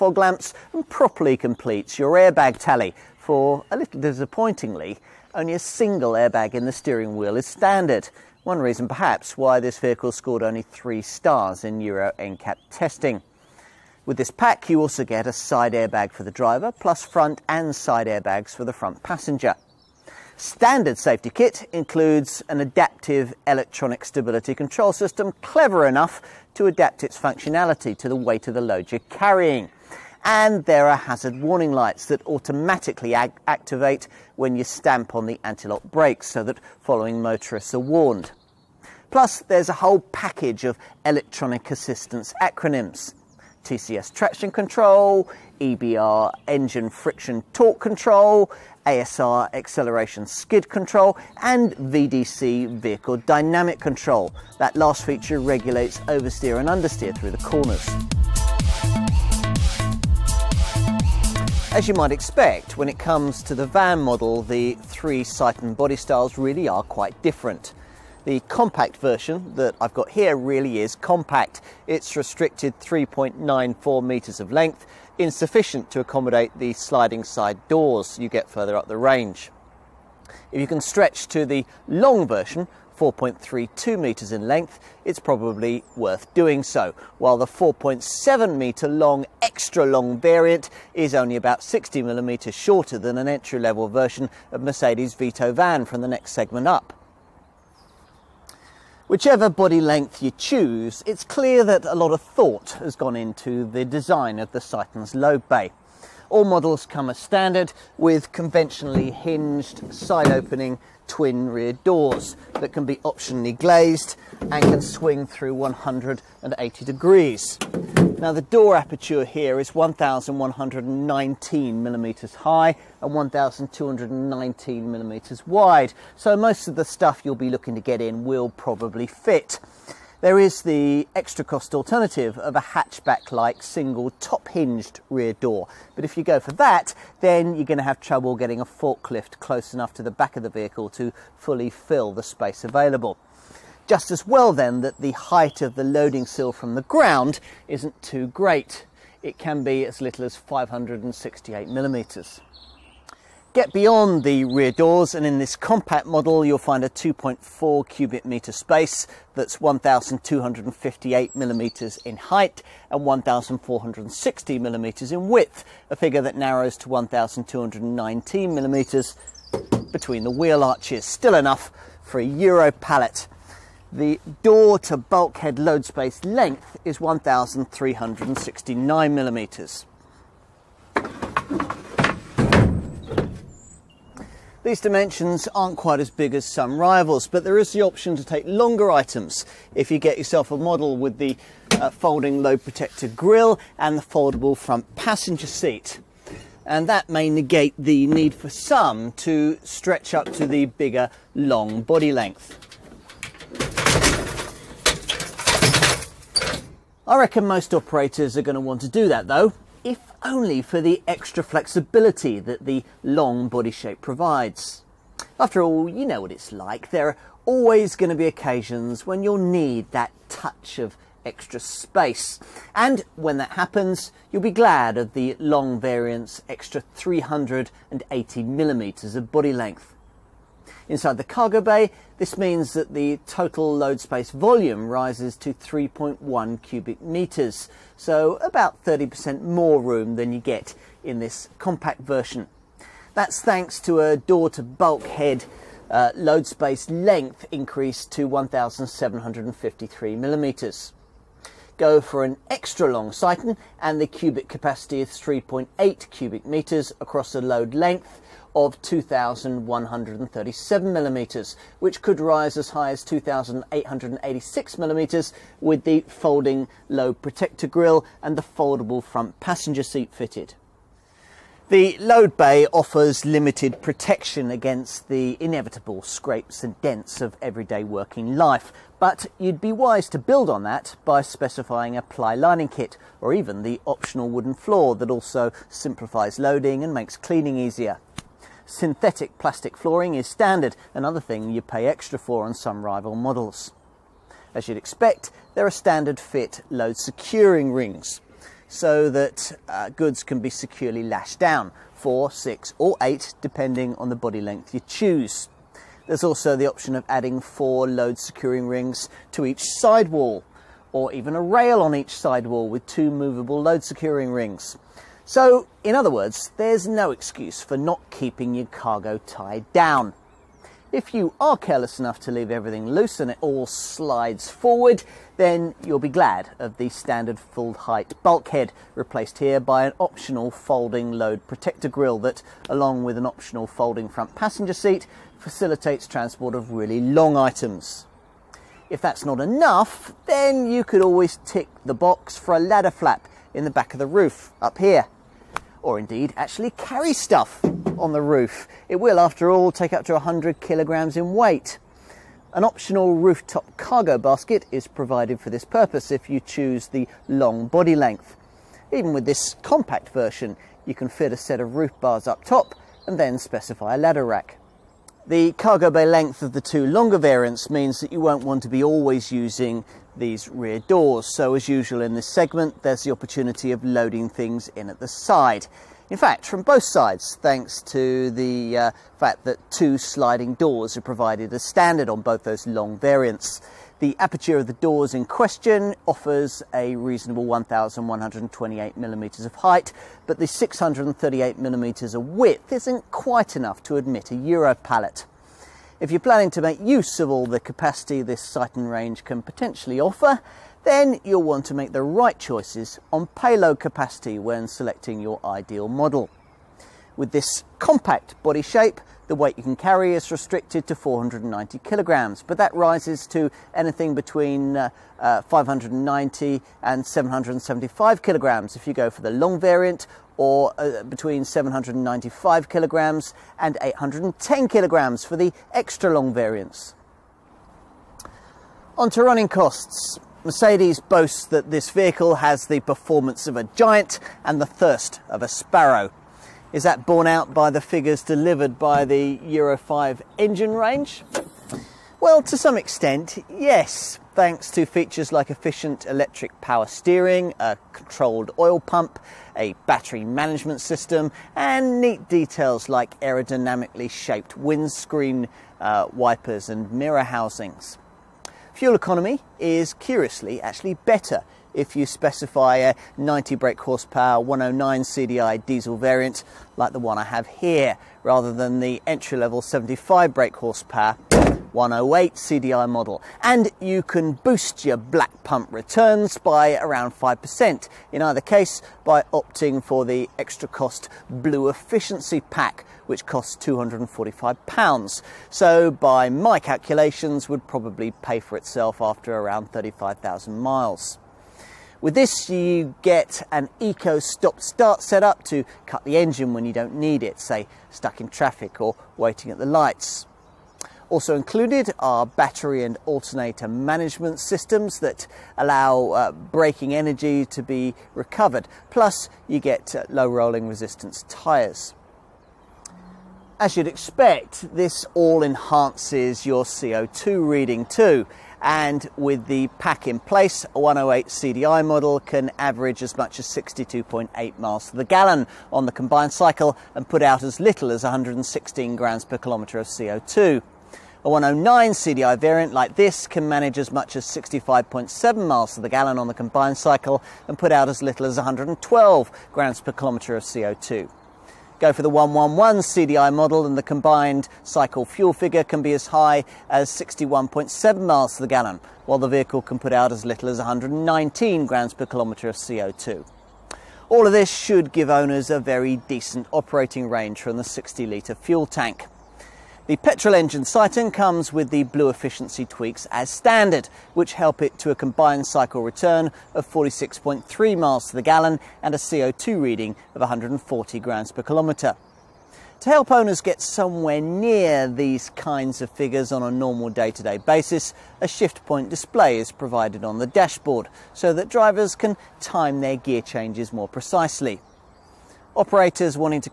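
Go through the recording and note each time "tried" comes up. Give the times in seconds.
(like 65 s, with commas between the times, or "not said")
not said.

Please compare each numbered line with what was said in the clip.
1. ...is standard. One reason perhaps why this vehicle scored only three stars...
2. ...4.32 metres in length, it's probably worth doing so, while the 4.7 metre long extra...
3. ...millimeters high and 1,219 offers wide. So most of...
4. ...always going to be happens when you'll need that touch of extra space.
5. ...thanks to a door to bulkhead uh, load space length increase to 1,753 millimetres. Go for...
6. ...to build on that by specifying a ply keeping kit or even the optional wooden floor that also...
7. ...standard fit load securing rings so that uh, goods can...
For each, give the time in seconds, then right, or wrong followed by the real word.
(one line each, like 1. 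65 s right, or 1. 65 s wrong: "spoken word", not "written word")
1. 7 s right
2. 82 s right
3. 121 s wrong: "millimeters", not "offers"
4. 217 s wrong: "occasions", not "happens"
5. 243 s right
6. 280 s wrong: "lining", not "keeping"
7. 295 s right.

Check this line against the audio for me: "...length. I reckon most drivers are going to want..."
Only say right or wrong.
wrong.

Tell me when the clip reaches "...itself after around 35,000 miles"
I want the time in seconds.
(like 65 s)
488 s.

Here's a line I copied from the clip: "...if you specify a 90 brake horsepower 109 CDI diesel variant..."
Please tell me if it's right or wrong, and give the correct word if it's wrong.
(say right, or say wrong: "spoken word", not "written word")
right.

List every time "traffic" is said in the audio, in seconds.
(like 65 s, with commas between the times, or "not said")
498 s.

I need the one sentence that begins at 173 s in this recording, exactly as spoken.
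The door to bulkhead load space length is 1,369 millimetres.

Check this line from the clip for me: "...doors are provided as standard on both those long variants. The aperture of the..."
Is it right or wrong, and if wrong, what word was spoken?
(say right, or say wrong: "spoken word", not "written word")
right.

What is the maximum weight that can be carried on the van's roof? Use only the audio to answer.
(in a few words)
100 kilograms.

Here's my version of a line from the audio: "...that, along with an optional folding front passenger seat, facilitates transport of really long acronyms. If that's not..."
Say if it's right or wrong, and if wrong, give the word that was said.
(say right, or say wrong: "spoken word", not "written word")
wrong: "items", not "acronyms".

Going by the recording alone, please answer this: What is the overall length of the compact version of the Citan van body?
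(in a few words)
3.94 metres.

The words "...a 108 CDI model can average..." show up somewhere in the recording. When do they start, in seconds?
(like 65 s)
520 s.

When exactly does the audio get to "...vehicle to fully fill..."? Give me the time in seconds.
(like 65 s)
140 s.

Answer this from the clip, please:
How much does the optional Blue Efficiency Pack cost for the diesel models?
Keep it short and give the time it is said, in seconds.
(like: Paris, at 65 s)
£245, at 483 s.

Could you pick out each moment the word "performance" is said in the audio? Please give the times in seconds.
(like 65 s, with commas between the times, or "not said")
432 s.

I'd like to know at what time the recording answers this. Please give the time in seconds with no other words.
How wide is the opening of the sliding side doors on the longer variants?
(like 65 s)
390 s.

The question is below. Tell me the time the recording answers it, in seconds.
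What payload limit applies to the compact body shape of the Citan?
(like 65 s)
410 s.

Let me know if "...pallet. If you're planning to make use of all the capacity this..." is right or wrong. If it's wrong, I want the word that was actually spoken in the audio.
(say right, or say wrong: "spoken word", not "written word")
right.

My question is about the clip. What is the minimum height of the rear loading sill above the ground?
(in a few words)
568 millimetres.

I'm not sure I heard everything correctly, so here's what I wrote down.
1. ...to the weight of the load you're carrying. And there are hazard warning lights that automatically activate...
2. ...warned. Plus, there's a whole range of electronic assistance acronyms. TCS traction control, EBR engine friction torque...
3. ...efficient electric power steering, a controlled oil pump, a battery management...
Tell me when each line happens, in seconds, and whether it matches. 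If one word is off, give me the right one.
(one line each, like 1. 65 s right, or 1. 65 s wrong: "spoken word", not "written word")
1. 27 s right
2. 37 s wrong: "package", not "range"
3. 445 s right.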